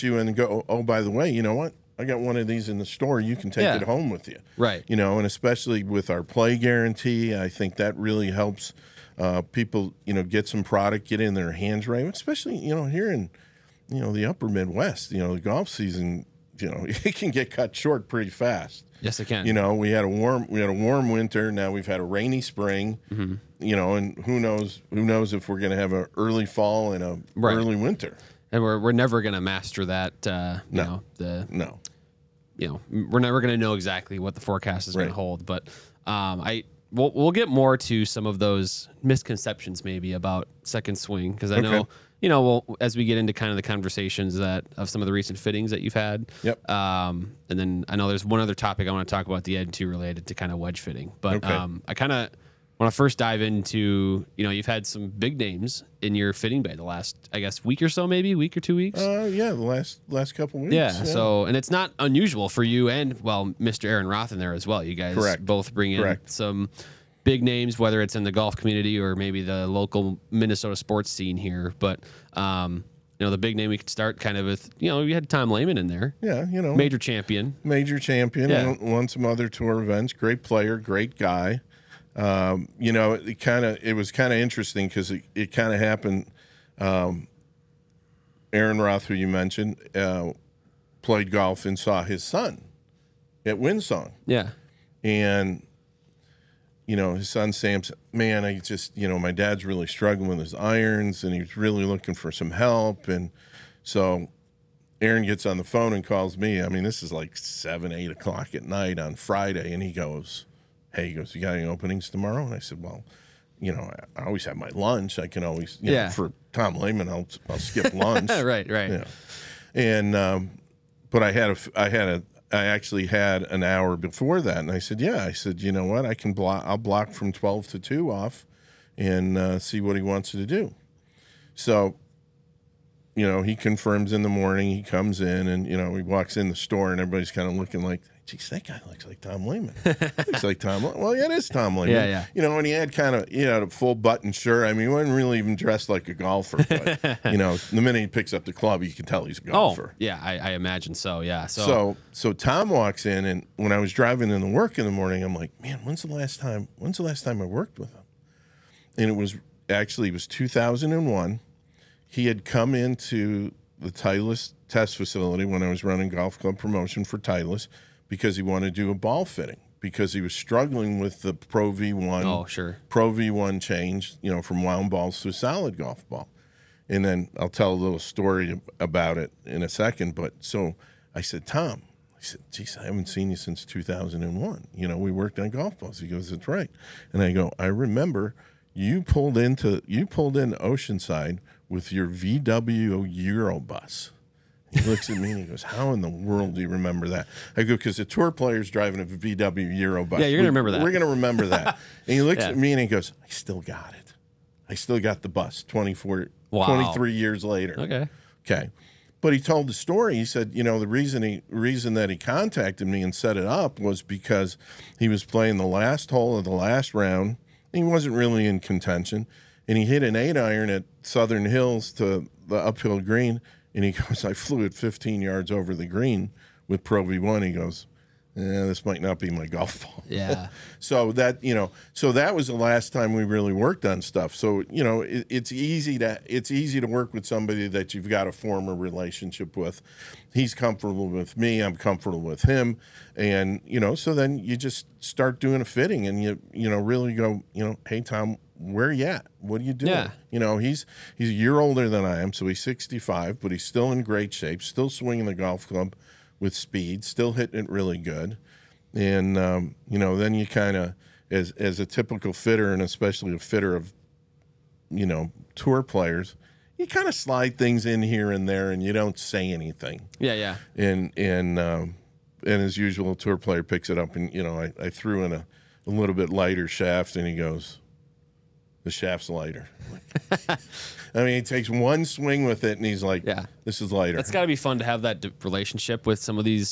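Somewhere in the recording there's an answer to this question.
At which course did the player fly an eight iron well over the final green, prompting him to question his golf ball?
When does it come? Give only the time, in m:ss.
3:41.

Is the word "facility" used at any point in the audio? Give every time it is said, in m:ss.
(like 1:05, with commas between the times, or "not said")
2:44.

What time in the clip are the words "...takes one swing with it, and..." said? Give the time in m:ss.
4:41.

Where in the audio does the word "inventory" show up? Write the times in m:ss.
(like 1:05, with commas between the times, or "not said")
not said.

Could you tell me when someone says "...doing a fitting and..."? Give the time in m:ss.
4:05.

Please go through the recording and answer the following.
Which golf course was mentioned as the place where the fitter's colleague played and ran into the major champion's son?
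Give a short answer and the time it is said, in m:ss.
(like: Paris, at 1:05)
Windsong, at 1:33.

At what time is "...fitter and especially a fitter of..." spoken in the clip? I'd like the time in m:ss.
4:22.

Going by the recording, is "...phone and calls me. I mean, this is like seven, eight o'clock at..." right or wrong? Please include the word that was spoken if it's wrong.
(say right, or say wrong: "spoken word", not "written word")
right.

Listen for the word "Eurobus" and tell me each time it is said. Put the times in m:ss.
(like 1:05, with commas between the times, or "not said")
3:13, 3:19.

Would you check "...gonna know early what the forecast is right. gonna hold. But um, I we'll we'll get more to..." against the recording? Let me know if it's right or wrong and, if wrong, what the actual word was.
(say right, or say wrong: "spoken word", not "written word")
wrong: "exactly", not "early".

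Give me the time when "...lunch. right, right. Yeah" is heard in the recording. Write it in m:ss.
1:57.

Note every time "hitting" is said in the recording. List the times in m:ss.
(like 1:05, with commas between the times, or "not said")
4:17.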